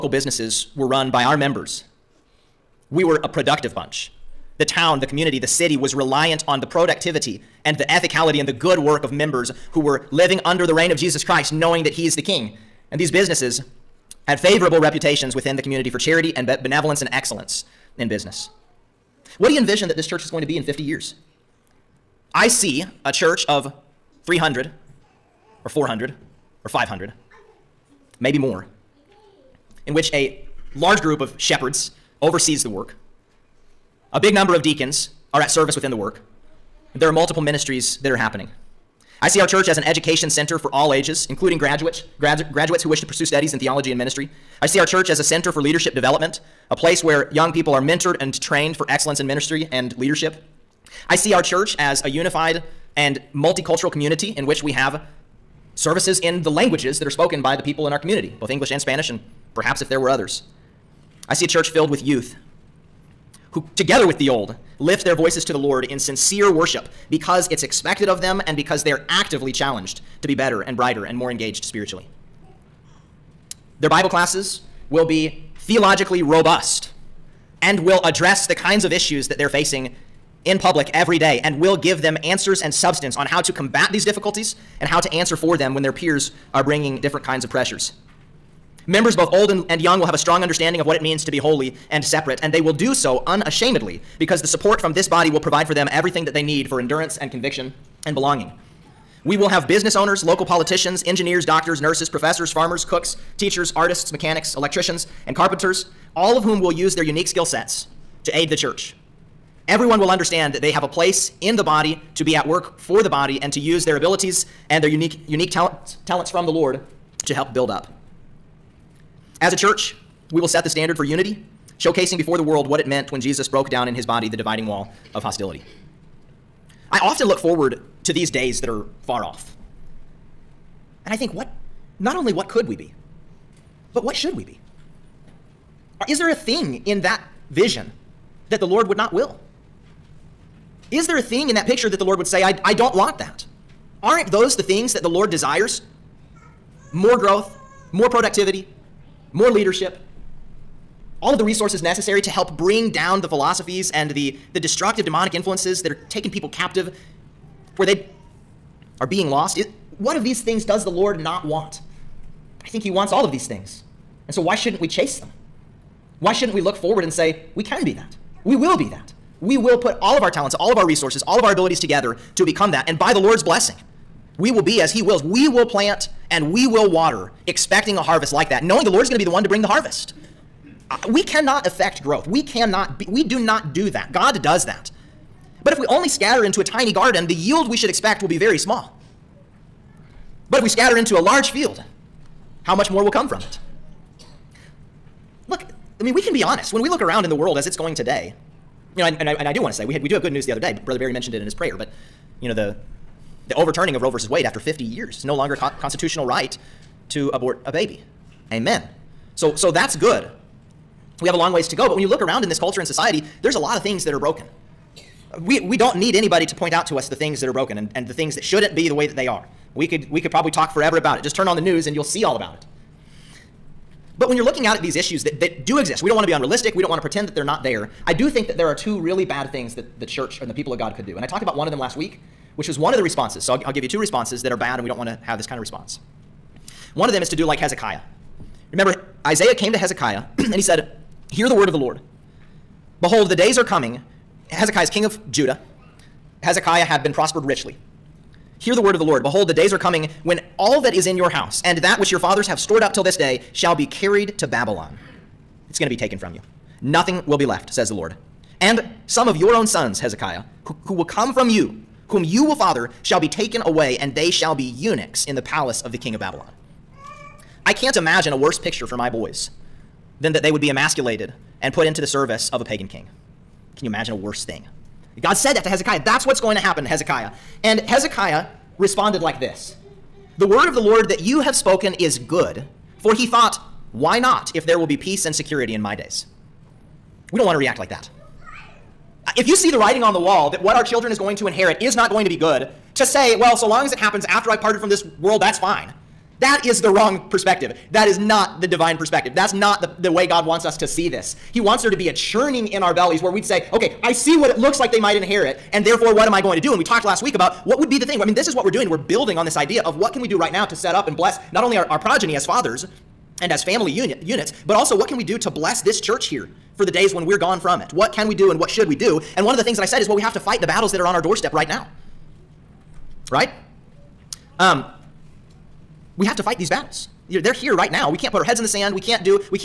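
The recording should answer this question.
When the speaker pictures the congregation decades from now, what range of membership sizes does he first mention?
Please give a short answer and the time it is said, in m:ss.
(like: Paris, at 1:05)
300 or 400, at 0:24.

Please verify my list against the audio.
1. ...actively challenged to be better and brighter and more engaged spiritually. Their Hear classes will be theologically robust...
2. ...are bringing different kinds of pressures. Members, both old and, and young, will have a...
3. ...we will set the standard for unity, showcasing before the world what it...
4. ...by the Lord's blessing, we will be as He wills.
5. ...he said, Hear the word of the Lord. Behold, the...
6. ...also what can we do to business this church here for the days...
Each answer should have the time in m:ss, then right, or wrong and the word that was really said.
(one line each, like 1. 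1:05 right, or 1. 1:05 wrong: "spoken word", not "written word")
1. 1:09 wrong: "Bible", not "Hear"
2. 1:26 right
3. 2:00 right
4. 2:52 right
5. 4:00 right
6. 5:14 wrong: "bless", not "business".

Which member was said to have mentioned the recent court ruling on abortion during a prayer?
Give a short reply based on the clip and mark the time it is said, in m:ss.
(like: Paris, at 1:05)
Brother Barry, at 3:20.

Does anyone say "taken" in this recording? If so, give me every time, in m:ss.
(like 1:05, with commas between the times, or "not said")
4:15, 4:23.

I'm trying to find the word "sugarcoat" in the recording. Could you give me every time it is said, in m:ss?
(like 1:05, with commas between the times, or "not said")
not said.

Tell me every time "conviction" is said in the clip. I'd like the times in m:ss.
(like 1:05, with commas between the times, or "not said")
1:37.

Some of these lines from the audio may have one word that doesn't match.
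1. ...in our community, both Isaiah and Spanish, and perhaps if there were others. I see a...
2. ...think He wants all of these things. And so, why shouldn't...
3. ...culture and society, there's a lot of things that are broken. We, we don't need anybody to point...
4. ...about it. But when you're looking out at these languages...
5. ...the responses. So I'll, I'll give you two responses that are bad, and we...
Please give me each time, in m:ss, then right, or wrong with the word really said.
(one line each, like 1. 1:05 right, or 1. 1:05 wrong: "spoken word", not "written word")
1. 0:57 wrong: "English", not "Isaiah"
2. 2:42 right
3. 3:32 right
4. 3:42 wrong: "issues", not "languages"
5. 3:52 right.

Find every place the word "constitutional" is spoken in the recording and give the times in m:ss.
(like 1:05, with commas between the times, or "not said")
3:25.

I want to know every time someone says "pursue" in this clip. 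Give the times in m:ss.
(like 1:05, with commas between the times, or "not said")
0:43.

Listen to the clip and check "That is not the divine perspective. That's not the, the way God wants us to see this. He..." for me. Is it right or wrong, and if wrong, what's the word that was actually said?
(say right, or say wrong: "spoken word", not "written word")
right.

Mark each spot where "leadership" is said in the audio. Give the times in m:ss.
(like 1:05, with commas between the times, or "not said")
0:45, 0:49, 2:29.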